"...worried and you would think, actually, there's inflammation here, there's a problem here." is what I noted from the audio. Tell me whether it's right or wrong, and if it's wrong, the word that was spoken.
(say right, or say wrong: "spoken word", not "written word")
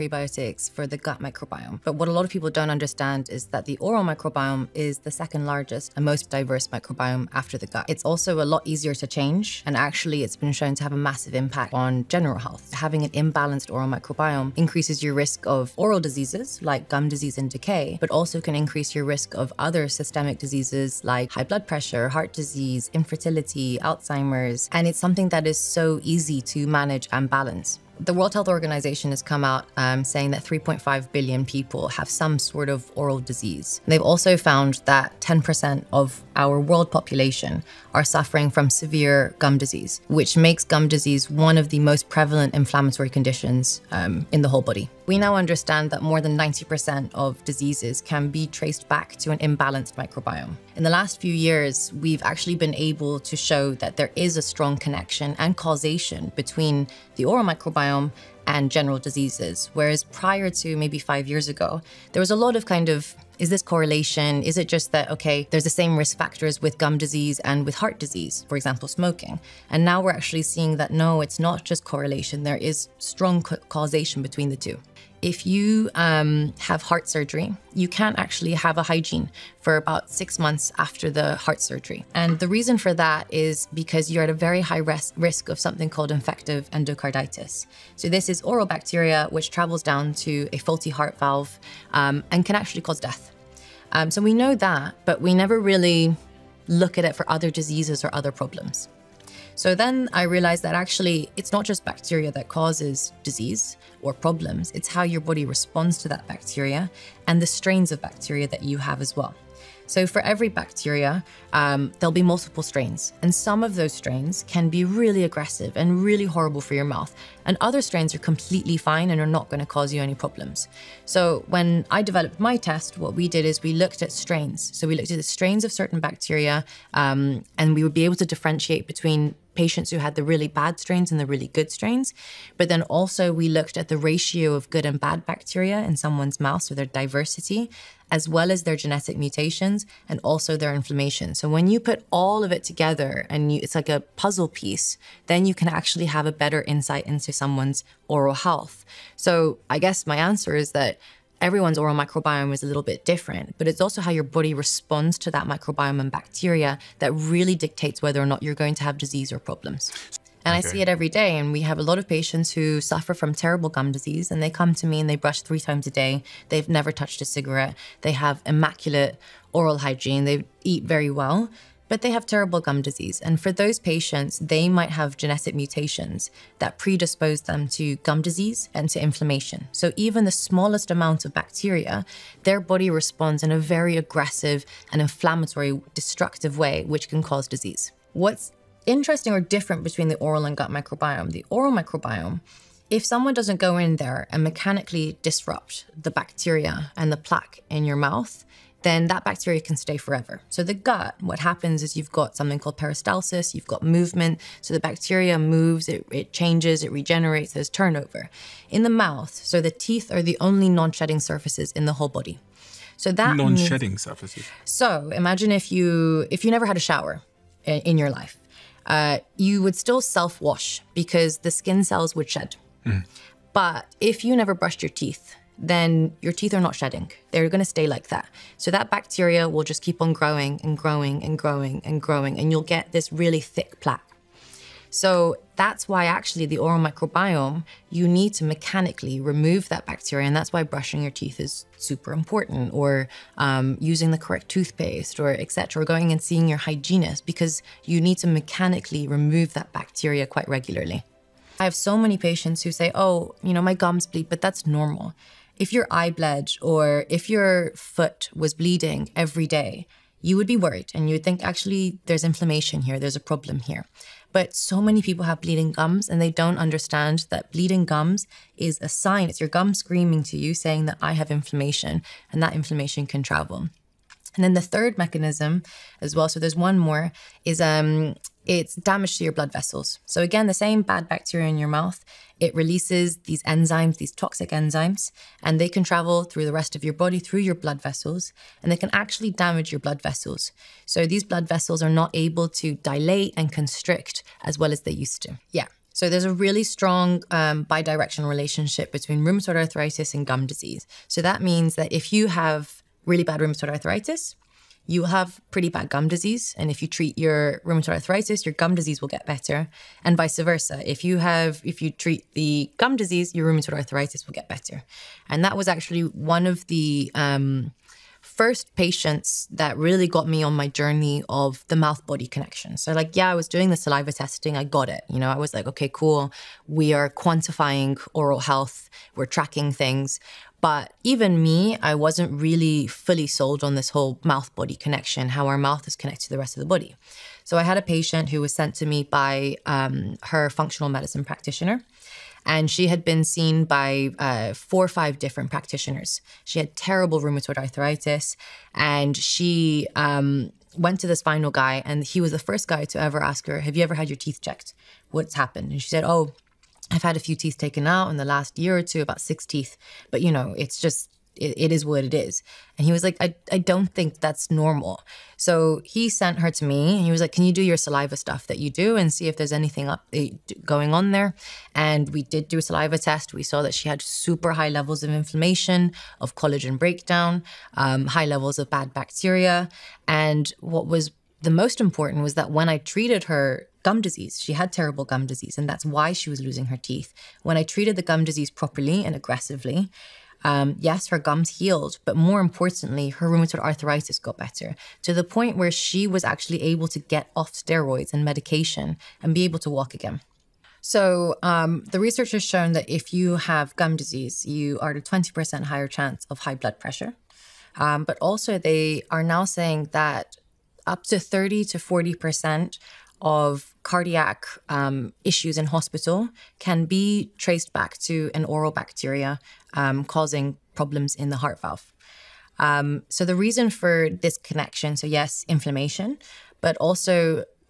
right.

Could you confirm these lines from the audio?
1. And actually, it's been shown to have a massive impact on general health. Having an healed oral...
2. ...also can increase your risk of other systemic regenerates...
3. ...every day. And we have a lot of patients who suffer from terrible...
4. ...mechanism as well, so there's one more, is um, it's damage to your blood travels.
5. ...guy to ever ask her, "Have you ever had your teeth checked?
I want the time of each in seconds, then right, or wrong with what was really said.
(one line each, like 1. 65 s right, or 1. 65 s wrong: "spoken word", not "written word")
1. 9 s wrong: "imbalanced", not "healed"
2. 18 s wrong: "diseases", not "regenerates"
3. 160 s right
4. 274 s wrong: "vessels", not "travels"
5. 352 s right.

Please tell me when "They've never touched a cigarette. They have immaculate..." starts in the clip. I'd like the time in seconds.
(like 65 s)
166 s.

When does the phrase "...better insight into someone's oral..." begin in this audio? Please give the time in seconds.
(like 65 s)
146 s.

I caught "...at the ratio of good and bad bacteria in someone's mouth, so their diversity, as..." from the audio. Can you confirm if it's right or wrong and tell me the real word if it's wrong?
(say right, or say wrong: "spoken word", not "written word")
right.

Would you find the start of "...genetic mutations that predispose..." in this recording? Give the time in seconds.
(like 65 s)
175 s.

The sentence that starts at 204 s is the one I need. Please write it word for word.
So the bacteria moves, it, it changes, it regenerates, there's turnover.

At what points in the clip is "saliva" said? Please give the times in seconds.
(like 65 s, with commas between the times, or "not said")
323 s, 367 s, 372 s.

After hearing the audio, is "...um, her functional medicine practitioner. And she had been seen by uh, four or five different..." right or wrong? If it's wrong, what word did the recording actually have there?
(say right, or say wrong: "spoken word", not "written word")
right.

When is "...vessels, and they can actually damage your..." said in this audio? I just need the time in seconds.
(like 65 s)
287 s.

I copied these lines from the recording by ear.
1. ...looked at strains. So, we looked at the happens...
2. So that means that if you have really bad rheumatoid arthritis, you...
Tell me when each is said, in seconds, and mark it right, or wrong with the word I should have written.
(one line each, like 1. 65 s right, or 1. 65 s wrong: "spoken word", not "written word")
1. 123 s wrong: "strains", not "happens"
2. 301 s right.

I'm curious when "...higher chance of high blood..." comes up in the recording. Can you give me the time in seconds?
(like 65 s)
405 s.